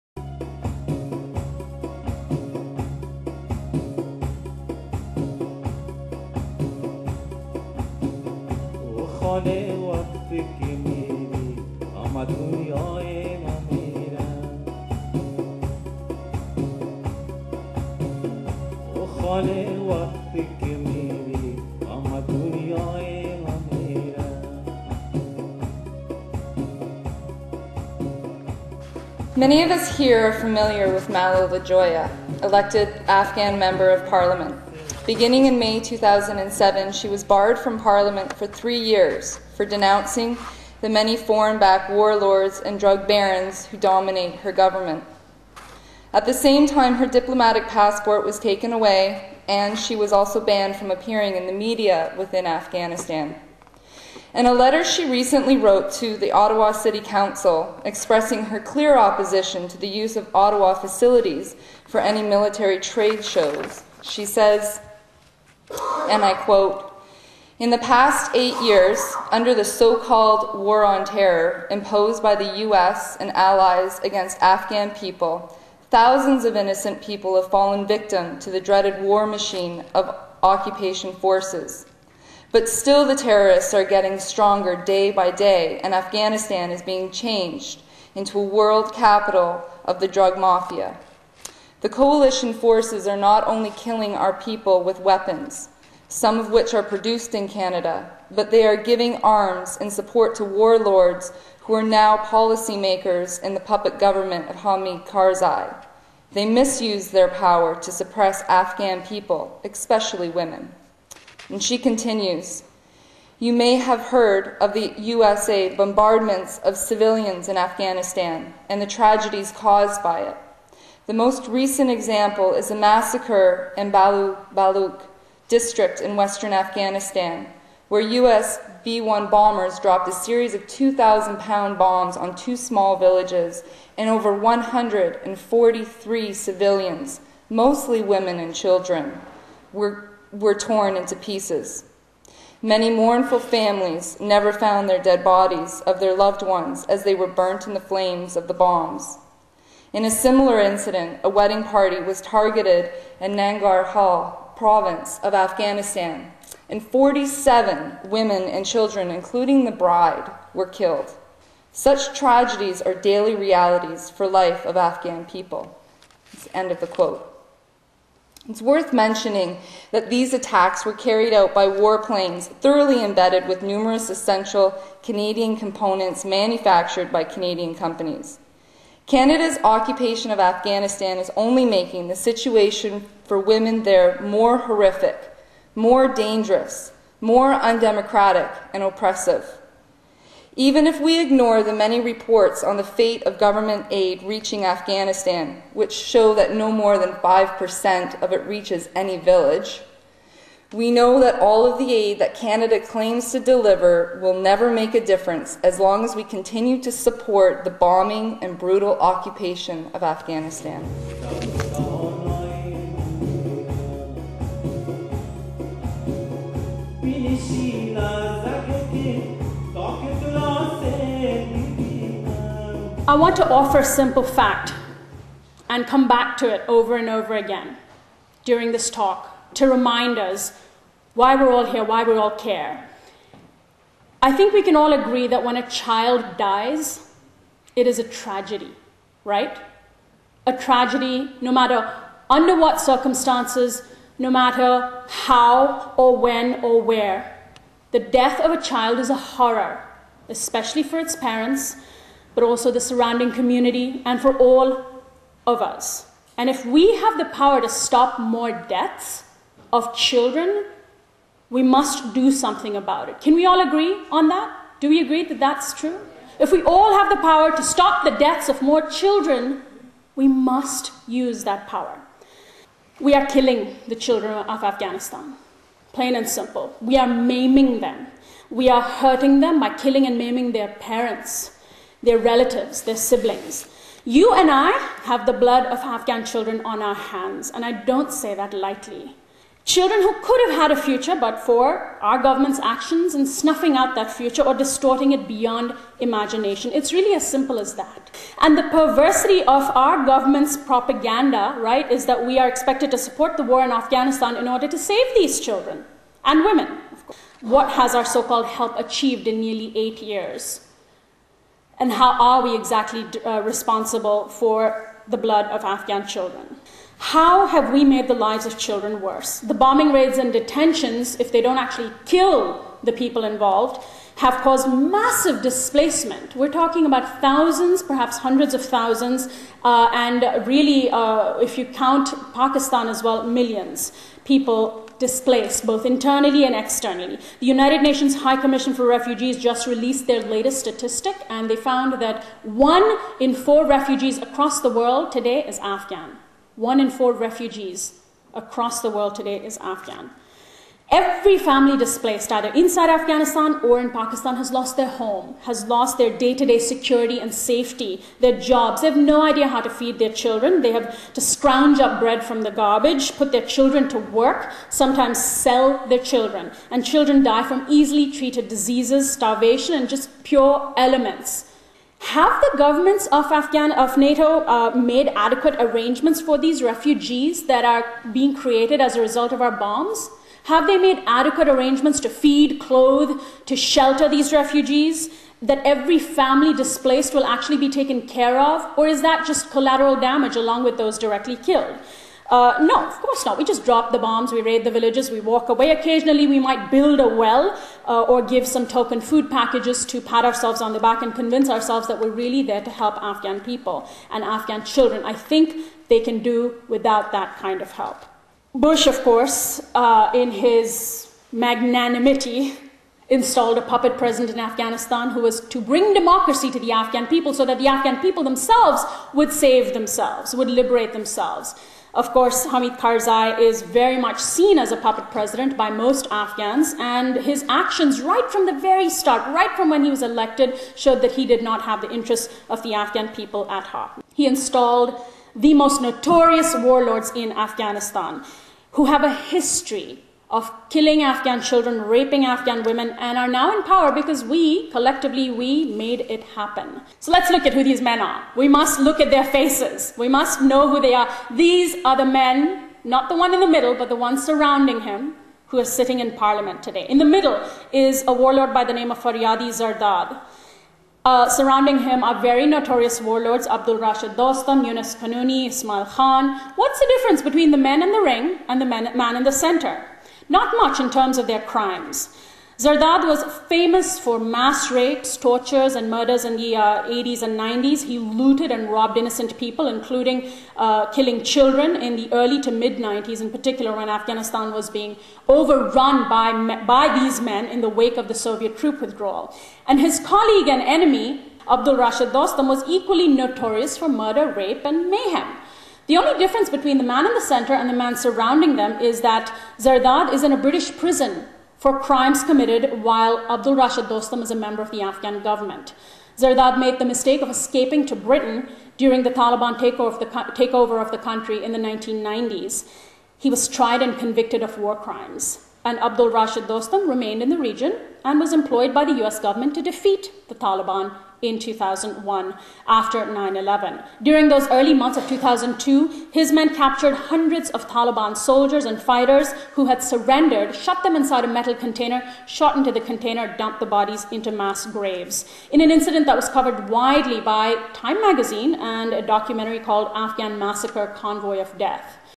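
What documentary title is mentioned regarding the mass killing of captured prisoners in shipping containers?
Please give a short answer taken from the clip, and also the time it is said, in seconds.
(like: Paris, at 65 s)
Afghan Massacre: Convoy of Death, at 539 s.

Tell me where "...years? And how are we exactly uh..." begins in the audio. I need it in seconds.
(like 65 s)
310 s.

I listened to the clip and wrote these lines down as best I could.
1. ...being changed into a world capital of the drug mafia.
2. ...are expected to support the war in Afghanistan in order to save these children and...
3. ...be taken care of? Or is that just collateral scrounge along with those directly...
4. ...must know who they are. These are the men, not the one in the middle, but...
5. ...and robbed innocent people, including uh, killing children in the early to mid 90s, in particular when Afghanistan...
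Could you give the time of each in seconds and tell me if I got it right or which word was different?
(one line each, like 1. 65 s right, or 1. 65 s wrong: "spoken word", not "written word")
1. 86 s right
2. 302 s right
3. 387 s wrong: "damage", not "scrounge"
4. 450 s right
5. 478 s right.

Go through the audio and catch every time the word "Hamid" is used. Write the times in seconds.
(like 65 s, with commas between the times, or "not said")
104 s, 422 s.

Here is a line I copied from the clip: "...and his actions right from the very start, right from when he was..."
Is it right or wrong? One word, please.
right.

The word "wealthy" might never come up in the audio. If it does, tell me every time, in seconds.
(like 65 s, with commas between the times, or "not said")
not said.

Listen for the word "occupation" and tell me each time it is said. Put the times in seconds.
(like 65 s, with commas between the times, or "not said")
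80 s, 179 s, 209 s.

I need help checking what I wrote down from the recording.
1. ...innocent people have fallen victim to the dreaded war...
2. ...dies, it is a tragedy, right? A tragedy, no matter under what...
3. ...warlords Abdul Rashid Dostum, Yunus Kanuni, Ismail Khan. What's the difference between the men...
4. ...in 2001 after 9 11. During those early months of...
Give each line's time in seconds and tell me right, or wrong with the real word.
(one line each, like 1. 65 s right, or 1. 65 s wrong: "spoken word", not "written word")
1. 76 s right
2. 236 s right
3. 463 s right
4. 521 s right.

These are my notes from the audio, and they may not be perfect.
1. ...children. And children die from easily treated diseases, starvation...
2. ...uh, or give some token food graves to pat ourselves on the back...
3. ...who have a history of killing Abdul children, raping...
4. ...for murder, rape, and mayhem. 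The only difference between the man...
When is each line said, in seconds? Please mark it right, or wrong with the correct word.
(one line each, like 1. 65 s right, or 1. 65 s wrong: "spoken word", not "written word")
1. 366 s right
2. 397 s wrong: "packages", not "graves"
3. 438 s wrong: "Afghan", not "Abdul"
4. 493 s right.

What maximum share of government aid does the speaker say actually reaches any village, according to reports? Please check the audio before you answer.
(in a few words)
5%.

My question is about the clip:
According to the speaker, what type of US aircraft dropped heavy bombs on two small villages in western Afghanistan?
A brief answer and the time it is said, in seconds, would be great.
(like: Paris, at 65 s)
B-1 bombers, at 128 s.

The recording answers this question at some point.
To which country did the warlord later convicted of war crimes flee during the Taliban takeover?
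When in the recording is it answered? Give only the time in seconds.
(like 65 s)
507 s.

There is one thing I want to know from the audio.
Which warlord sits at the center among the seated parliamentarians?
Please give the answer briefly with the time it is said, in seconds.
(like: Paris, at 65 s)
Faryadi Zardad, at 458 s.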